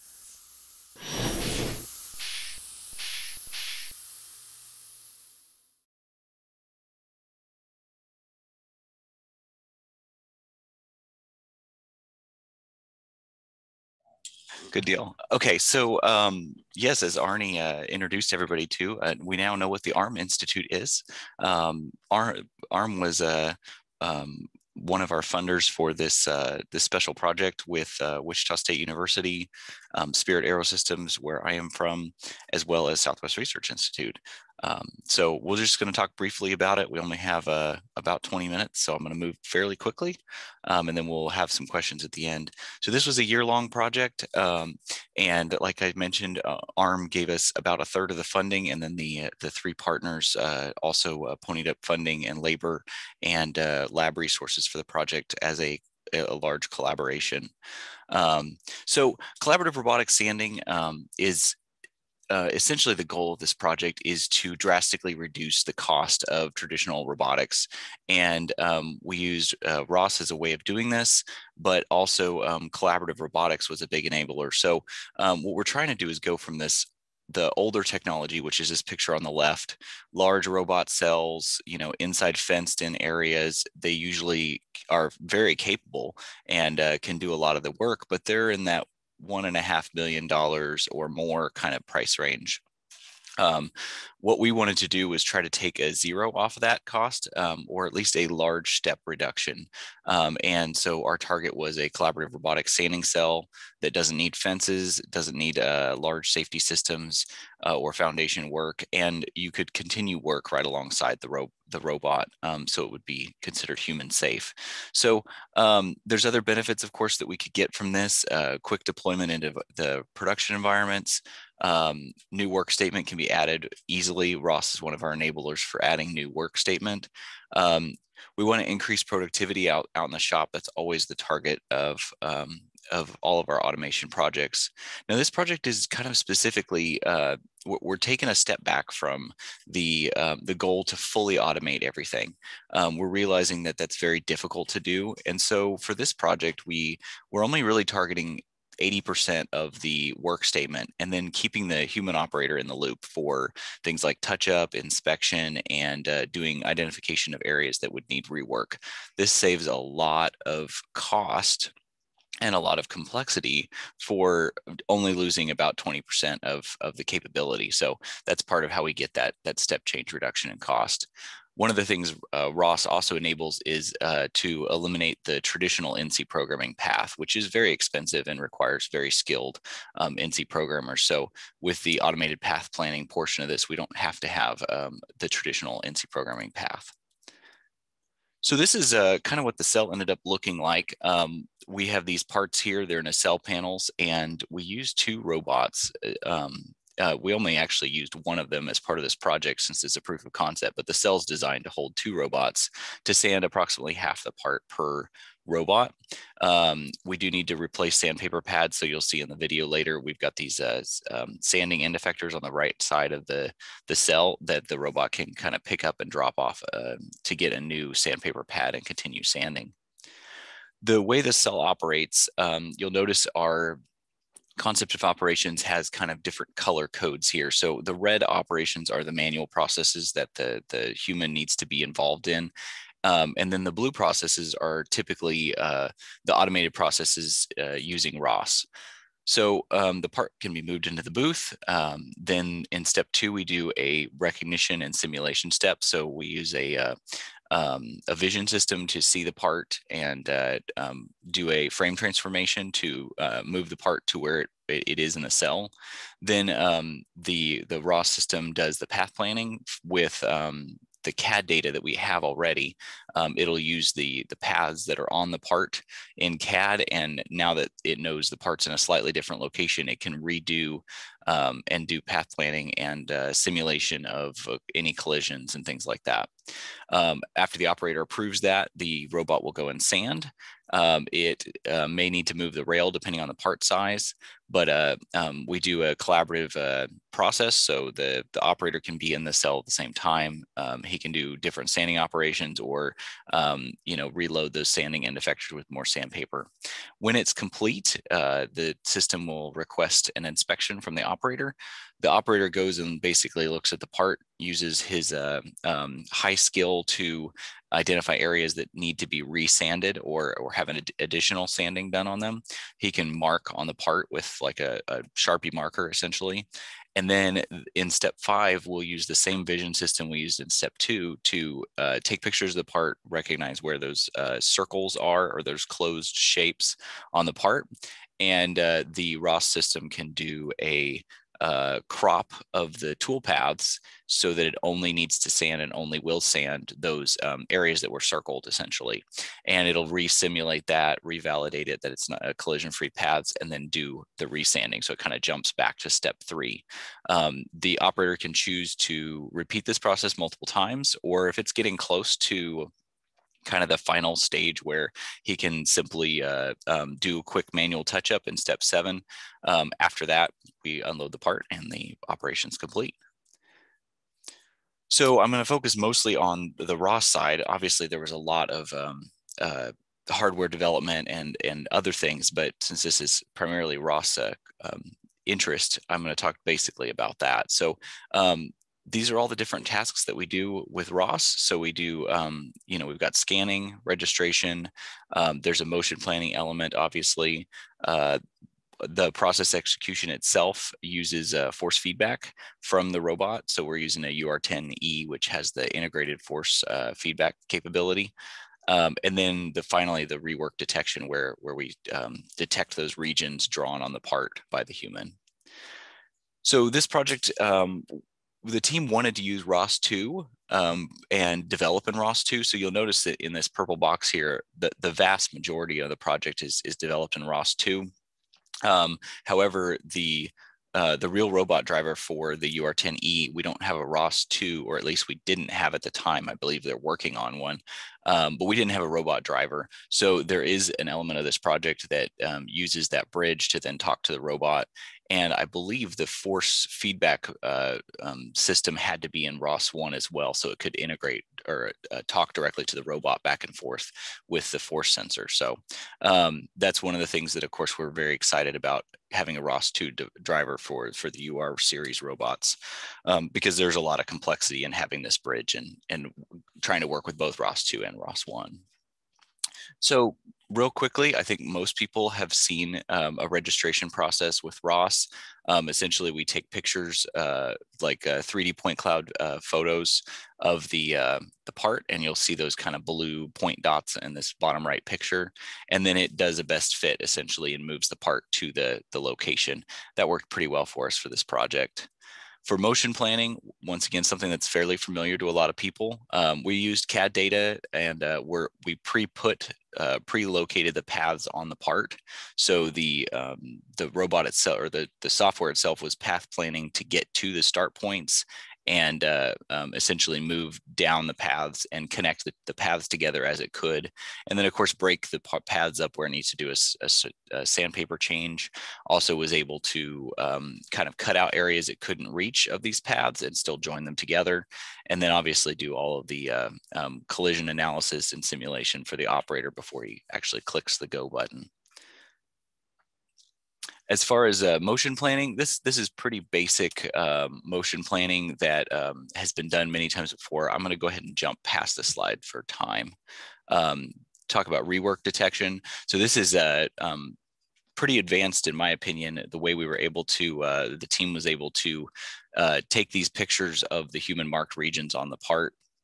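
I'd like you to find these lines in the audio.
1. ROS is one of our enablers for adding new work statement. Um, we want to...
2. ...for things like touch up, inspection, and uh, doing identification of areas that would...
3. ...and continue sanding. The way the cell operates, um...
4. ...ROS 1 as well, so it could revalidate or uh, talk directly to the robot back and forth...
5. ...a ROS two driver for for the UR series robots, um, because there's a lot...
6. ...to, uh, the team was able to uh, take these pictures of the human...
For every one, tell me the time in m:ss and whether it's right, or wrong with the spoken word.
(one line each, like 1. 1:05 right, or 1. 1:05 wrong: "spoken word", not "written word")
1. 2:04 right
2. 2:33 right
3. 3:38 right
4. 7:19 wrong: "integrate", not "revalidate"
5. 7:29 right
6. 9:00 right.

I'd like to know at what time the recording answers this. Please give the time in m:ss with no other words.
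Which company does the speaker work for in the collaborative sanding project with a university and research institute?
0:30.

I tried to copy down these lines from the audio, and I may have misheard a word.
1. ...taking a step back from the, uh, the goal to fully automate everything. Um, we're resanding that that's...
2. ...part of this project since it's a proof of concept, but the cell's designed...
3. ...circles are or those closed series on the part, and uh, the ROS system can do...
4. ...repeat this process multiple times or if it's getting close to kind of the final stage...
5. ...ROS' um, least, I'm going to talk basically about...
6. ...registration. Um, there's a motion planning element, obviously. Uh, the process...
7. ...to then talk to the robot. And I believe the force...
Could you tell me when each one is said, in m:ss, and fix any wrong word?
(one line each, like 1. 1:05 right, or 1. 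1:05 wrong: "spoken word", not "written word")
1. 2:17 wrong: "realizing", not "resanding"
2. 3:18 right
3. 5:24 wrong: "shapes", not "series"
4. 5:49 right
5. 6:13 wrong: "interest", not "least"
6. 6:23 right
7. 7:13 right.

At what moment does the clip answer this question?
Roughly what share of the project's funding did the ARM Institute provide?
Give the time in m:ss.
0:47.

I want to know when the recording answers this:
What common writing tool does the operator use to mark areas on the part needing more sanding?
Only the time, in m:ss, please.
5:15.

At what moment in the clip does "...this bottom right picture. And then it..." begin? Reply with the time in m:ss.
7:54.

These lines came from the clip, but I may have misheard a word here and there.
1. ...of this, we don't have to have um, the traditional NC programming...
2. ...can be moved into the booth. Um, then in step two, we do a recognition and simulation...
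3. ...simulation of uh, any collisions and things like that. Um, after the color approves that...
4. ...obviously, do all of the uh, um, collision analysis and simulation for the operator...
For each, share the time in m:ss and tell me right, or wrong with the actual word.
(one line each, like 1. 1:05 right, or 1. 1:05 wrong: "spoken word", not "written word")
1. 3:03 right
2. 4:00 right
3. 4:33 wrong: "operator", not "color"
4. 8:35 right.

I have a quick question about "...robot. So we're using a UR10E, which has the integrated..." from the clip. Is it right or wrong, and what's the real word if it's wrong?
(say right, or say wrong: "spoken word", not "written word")
right.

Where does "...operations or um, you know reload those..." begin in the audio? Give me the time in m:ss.
4:51.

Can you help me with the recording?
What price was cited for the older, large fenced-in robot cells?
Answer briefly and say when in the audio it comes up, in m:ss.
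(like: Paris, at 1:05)
1.5 million dollars, at 1:29.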